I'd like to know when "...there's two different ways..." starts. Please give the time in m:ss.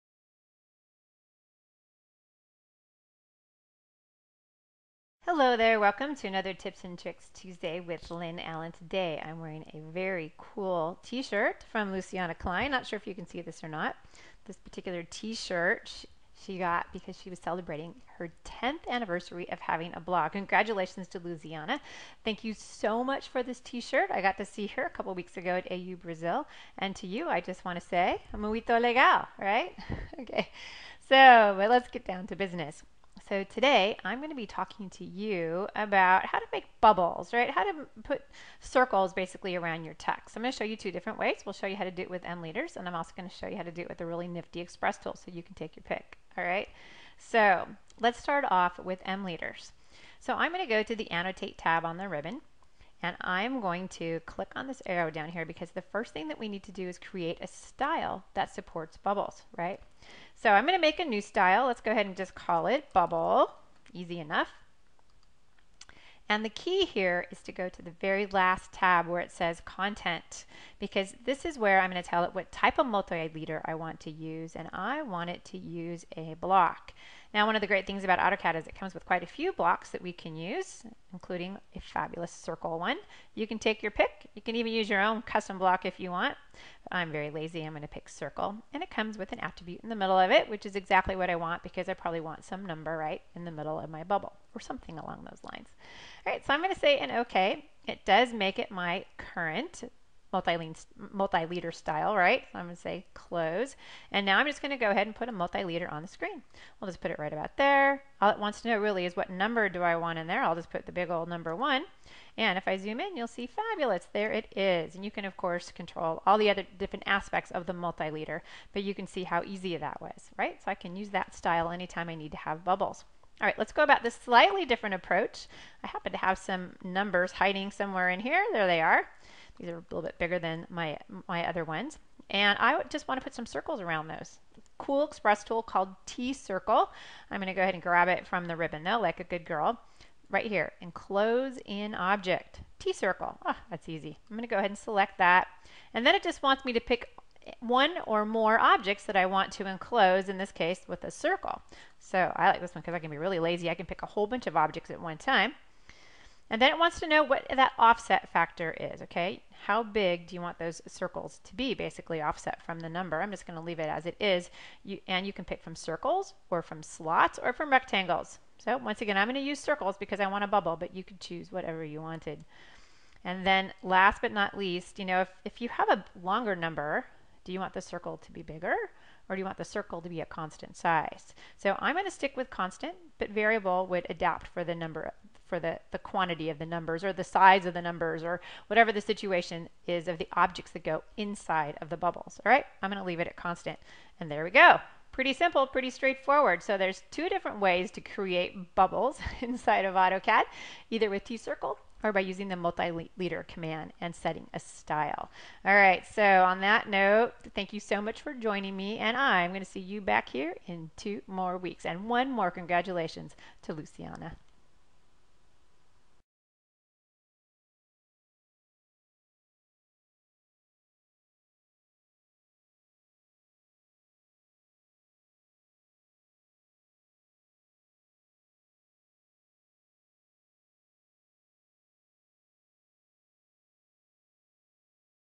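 3:16.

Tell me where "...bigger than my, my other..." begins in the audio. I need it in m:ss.
2:10.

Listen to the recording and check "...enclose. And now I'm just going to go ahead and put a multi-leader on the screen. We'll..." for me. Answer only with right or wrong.
wrong.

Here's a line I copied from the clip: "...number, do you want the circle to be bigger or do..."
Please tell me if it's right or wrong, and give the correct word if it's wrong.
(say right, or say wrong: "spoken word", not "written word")
right.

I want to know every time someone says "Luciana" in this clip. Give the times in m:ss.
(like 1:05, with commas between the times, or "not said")
0:11, 0:21, 3:33.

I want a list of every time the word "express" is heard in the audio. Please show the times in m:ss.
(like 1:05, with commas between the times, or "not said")
0:44, 2:15.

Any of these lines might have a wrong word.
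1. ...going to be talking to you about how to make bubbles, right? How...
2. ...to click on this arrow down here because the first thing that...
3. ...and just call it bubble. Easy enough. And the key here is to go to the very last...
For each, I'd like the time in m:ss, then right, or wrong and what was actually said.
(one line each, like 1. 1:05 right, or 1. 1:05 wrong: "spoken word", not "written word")
1. 0:34 right
2. 0:53 right
3. 1:02 right.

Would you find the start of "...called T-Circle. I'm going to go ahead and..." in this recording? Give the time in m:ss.
2:15.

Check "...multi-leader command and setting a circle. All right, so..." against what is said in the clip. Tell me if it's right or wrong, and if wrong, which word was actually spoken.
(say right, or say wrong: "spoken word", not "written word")
wrong: "style", not "circle".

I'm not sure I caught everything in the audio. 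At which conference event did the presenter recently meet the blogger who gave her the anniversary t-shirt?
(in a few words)
AU Brazil.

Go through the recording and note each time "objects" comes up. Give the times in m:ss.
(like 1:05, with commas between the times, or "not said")
2:21, 2:28, 2:34, 3:10.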